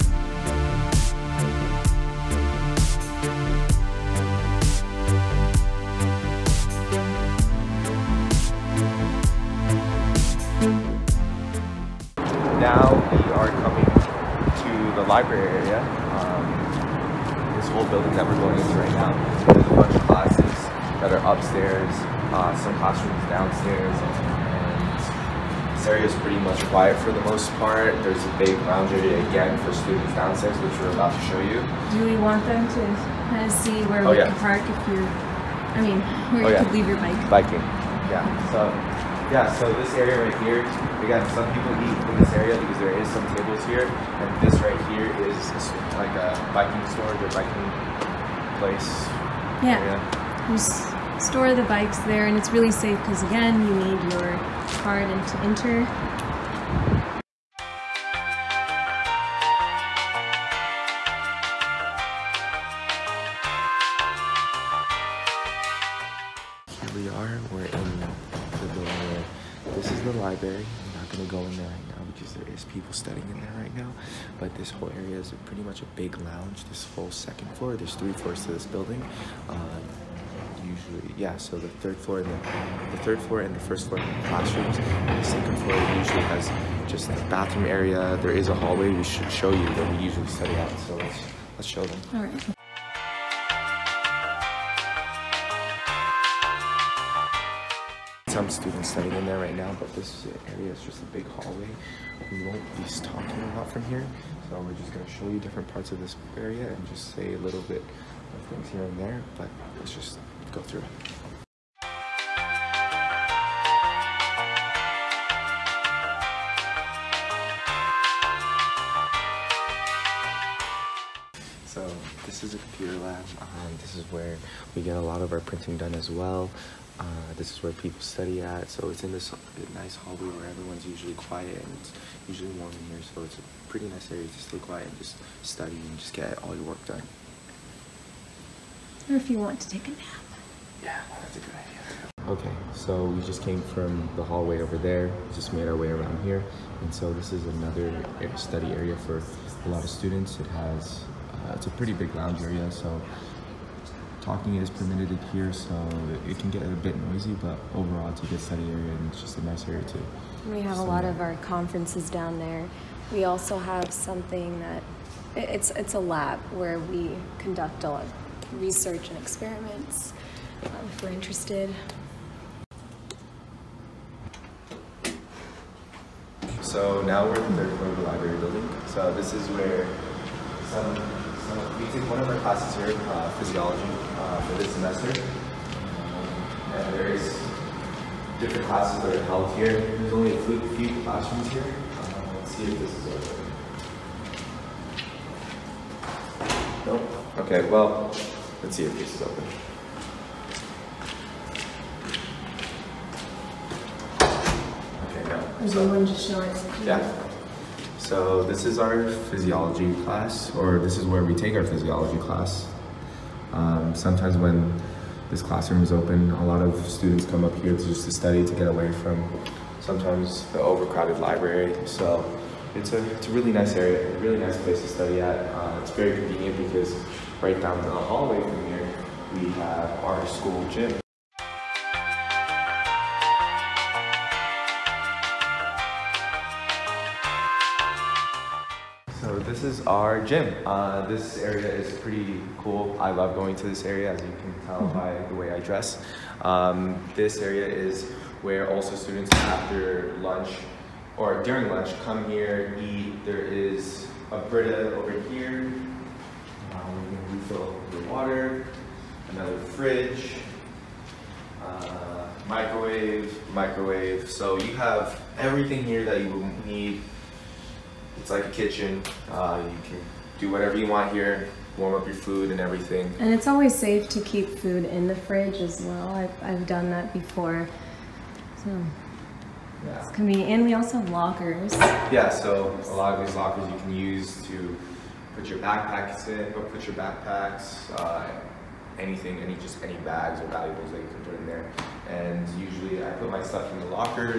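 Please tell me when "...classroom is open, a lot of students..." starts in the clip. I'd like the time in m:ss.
3:35.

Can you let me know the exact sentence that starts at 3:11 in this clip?
Um, let's see if this is over.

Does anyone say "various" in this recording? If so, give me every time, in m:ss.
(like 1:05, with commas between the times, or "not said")
3:06.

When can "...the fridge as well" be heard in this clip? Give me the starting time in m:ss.
4:35.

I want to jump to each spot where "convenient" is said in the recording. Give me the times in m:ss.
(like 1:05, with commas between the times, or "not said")
3:46, 4:40.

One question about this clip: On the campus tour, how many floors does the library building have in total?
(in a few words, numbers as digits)
3.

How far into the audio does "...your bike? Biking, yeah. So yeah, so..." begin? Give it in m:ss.
0:36.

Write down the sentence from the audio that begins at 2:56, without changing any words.
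So now we're in the third floor of the library building.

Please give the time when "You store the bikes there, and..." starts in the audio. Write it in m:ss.
0:50.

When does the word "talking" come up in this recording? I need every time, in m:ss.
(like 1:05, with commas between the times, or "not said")
1:43, 2:34.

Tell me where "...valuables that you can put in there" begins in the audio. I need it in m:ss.
4:50.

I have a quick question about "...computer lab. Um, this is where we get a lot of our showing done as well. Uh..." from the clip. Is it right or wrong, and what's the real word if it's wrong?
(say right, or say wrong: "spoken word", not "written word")
wrong: "printing", not "showing".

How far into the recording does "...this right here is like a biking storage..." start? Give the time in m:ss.
0:44.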